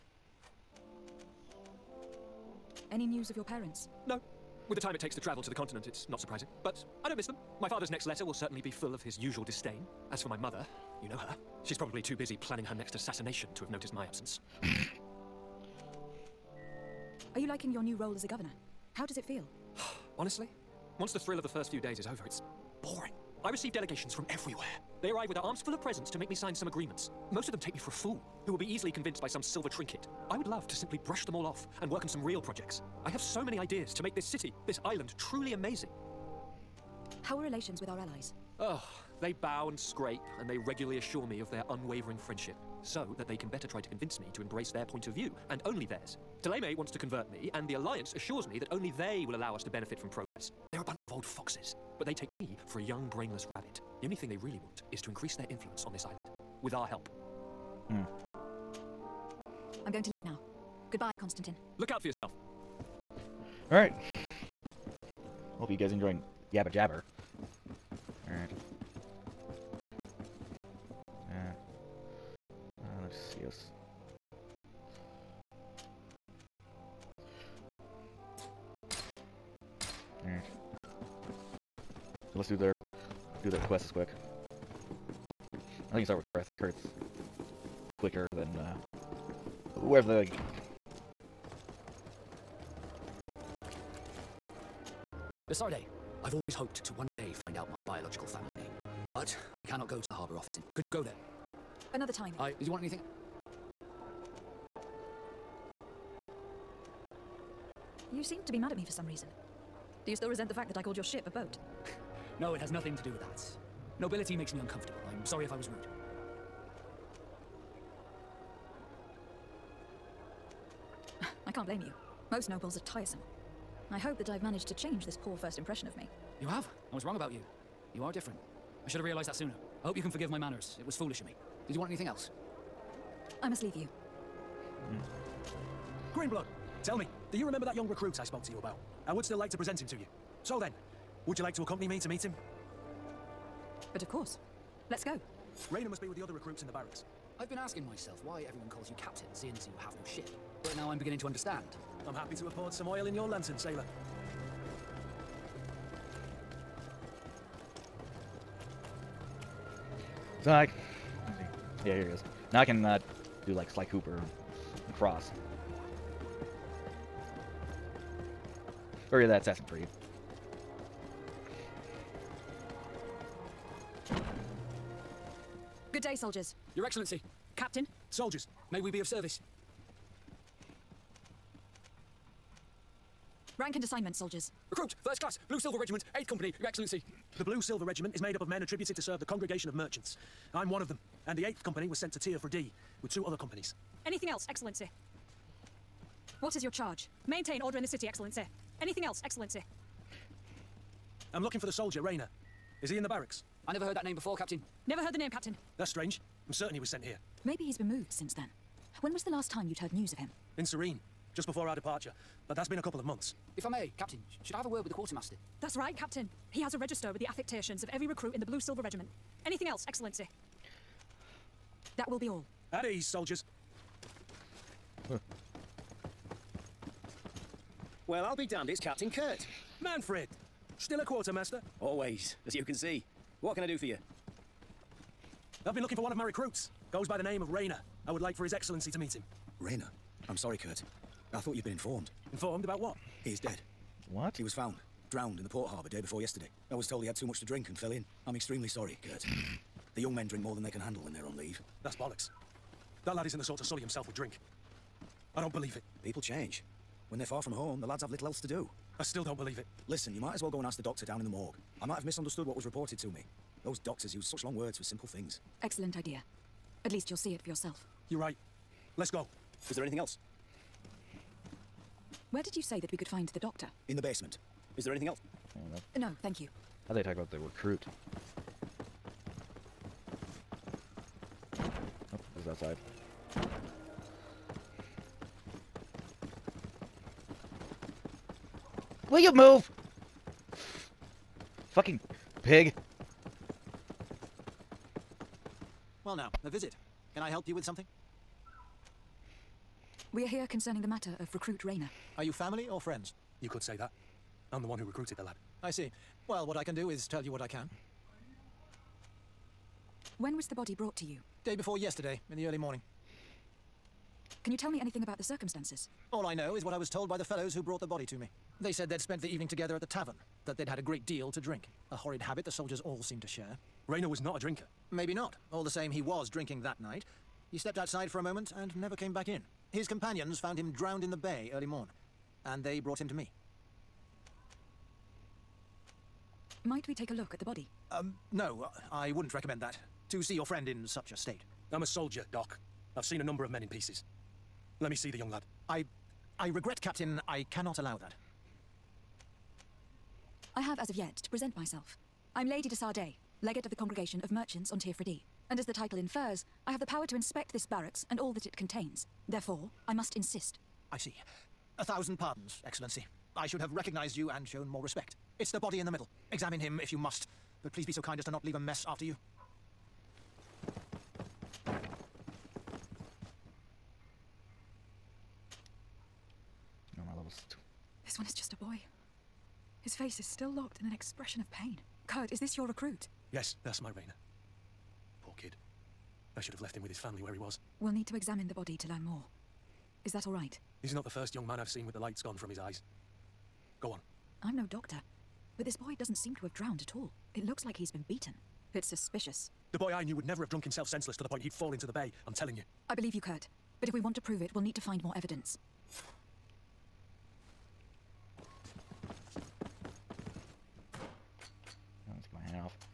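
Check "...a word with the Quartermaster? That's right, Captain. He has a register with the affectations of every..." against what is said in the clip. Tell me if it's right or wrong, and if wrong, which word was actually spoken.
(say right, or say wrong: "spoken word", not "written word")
right.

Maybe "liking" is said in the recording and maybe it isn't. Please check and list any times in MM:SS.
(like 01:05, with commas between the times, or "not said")
00:17.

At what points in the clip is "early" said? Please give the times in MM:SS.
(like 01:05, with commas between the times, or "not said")
05:12, 05:31.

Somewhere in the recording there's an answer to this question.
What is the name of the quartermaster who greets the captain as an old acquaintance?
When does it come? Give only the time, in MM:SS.
03:49.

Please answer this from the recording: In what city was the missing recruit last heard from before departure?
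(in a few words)
Serene.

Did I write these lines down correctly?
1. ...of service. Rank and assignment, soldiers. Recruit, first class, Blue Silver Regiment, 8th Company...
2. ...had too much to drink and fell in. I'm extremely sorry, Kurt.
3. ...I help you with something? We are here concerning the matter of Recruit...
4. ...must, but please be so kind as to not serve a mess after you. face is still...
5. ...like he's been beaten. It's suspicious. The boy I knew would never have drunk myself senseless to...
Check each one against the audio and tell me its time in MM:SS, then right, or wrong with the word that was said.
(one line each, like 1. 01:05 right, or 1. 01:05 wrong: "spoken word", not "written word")
1. 02:58 right
2. 04:07 right
3. 04:57 right
4. 06:06 wrong: "leave", not "serve"
5. 06:37 wrong: "himself", not "myself".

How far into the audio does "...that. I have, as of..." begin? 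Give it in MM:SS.
05:47.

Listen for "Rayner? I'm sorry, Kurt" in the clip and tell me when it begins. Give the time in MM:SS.
03:59.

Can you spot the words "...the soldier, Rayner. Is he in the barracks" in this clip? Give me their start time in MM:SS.
03:21.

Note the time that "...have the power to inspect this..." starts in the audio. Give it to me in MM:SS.
05:56.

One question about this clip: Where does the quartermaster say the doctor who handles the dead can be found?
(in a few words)
In the basement.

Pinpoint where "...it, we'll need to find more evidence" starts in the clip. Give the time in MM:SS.
06:44.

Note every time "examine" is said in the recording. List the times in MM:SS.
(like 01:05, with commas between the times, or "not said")
06:06, 06:28.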